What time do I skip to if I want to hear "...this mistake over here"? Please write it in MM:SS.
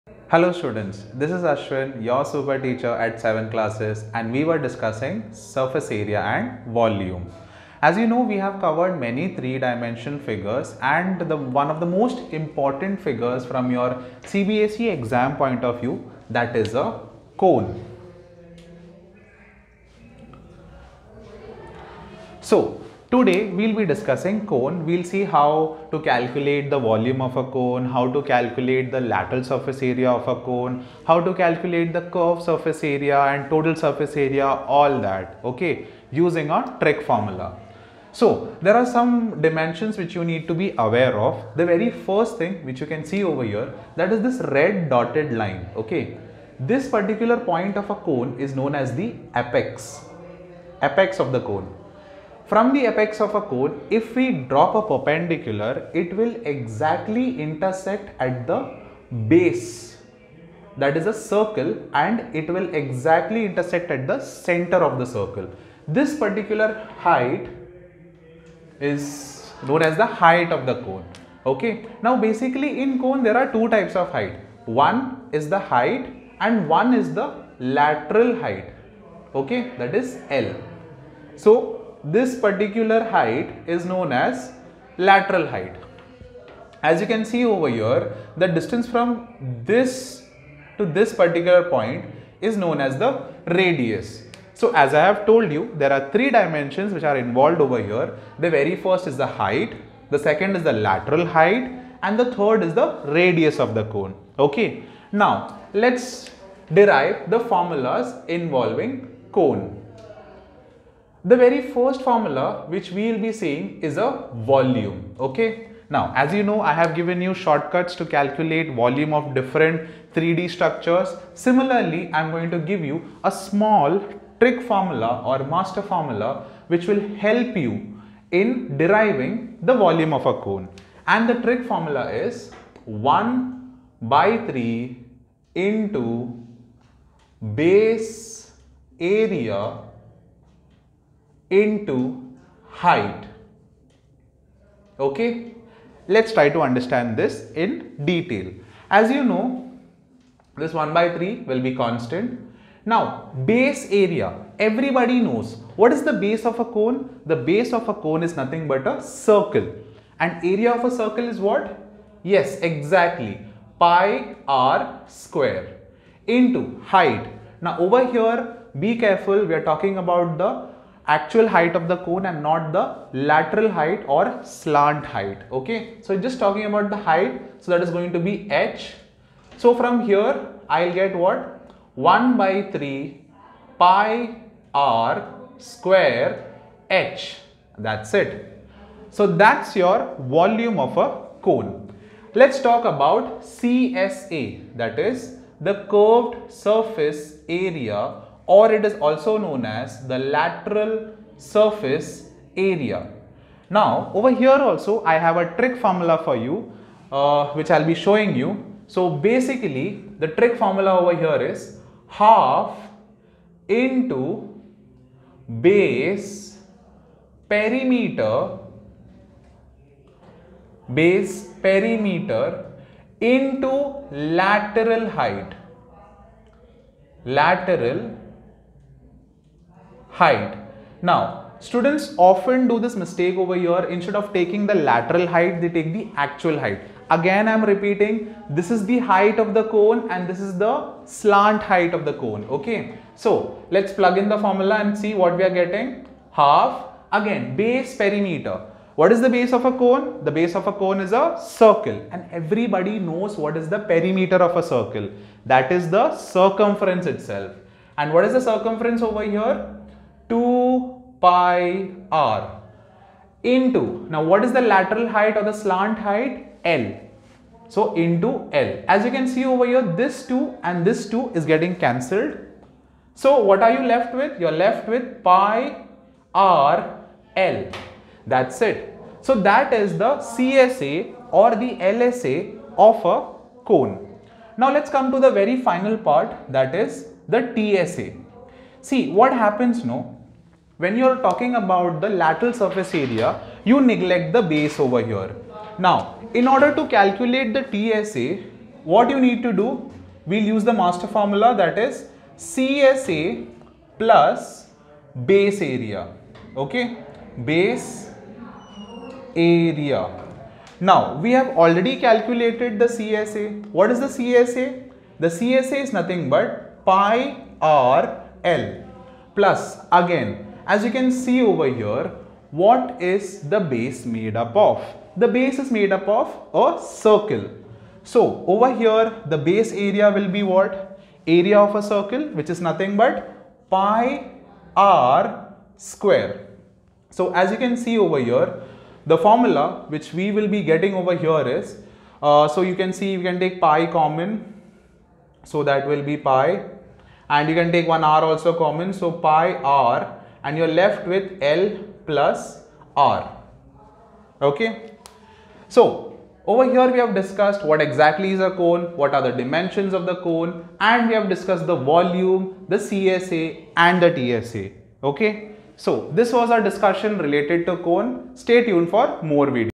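03:52.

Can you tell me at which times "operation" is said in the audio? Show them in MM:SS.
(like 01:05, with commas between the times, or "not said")
not said.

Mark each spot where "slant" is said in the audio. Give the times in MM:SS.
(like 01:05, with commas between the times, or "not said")
02:54, 04:01, 04:25.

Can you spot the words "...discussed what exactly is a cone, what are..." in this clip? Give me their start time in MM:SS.
05:57.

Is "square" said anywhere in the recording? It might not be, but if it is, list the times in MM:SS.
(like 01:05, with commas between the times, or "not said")
02:45, 03:05, 05:35.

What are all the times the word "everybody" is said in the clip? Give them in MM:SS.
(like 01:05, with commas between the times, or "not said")
02:34, 04:12.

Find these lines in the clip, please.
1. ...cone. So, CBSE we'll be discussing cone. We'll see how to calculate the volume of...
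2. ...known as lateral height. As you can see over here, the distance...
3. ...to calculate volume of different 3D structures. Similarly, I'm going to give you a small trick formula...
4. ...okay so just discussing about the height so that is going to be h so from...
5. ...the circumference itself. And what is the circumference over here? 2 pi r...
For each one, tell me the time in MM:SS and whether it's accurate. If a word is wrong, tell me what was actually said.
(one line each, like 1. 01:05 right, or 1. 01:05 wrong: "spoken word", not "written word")
1. 00:17 wrong: "Today", not "CBSE"
2. 01:23 right
3. 01:57 right
4. 02:55 wrong: "talking", not "discussing"
5. 04:15 right.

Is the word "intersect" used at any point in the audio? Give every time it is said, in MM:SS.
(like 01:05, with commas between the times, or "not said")
00:57, 01:03.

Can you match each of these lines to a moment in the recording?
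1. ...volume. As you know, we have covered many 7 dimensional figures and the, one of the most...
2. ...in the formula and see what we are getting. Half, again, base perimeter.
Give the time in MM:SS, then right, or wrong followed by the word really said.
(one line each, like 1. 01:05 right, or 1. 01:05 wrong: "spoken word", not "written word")
1. 00:06 wrong: "3", not "7"
2. 04:04 right.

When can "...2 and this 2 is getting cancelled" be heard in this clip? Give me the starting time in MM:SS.
04:30.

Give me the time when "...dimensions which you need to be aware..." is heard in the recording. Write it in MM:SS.
00:39.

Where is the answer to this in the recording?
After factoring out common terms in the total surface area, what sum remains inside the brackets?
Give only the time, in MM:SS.
05:51.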